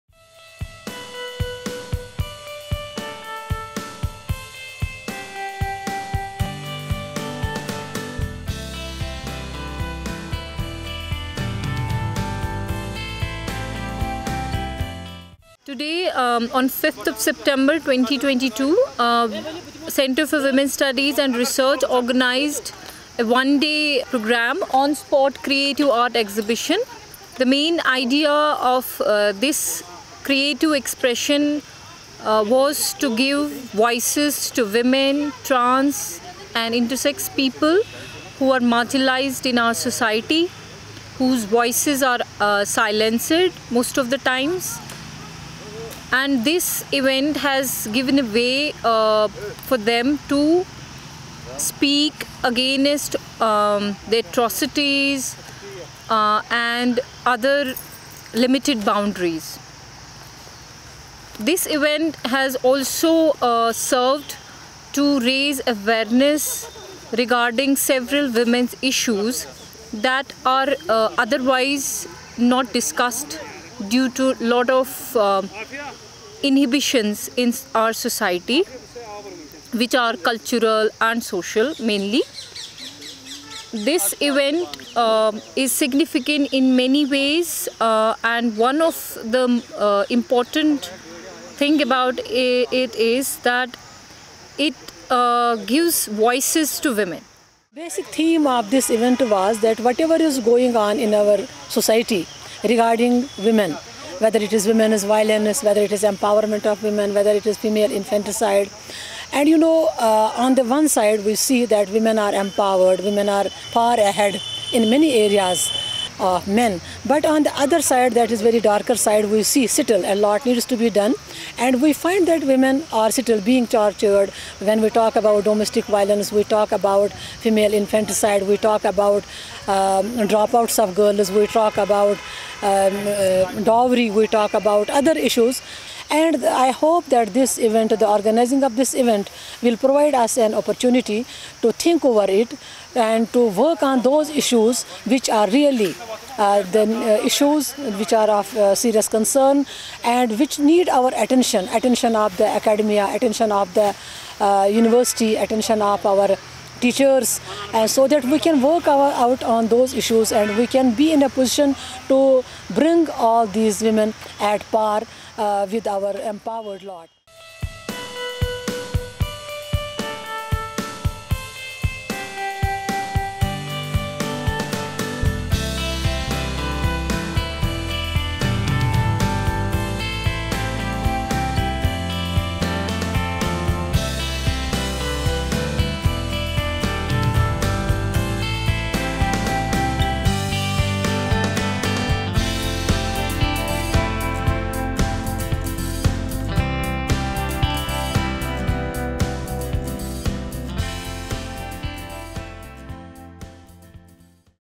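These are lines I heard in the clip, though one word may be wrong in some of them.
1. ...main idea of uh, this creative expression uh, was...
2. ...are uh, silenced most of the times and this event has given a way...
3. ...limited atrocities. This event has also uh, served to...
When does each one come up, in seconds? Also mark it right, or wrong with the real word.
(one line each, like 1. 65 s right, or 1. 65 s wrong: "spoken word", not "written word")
1. 27 s right
2. 42 s right
3. 58 s wrong: "boundaries", not "atrocities".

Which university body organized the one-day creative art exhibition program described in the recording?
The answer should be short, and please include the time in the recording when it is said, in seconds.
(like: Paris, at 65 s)
Center for Women's Studies and Research, at 19 s.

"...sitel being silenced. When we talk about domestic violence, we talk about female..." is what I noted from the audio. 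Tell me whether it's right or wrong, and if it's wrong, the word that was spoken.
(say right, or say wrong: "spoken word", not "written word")
wrong: "tortured", not "silenced".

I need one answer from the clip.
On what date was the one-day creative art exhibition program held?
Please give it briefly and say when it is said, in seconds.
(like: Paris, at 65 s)
5 September 2022, at 16 s.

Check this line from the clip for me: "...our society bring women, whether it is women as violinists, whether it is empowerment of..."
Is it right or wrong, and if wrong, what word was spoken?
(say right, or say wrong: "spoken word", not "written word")
wrong: "regarding", not "bring".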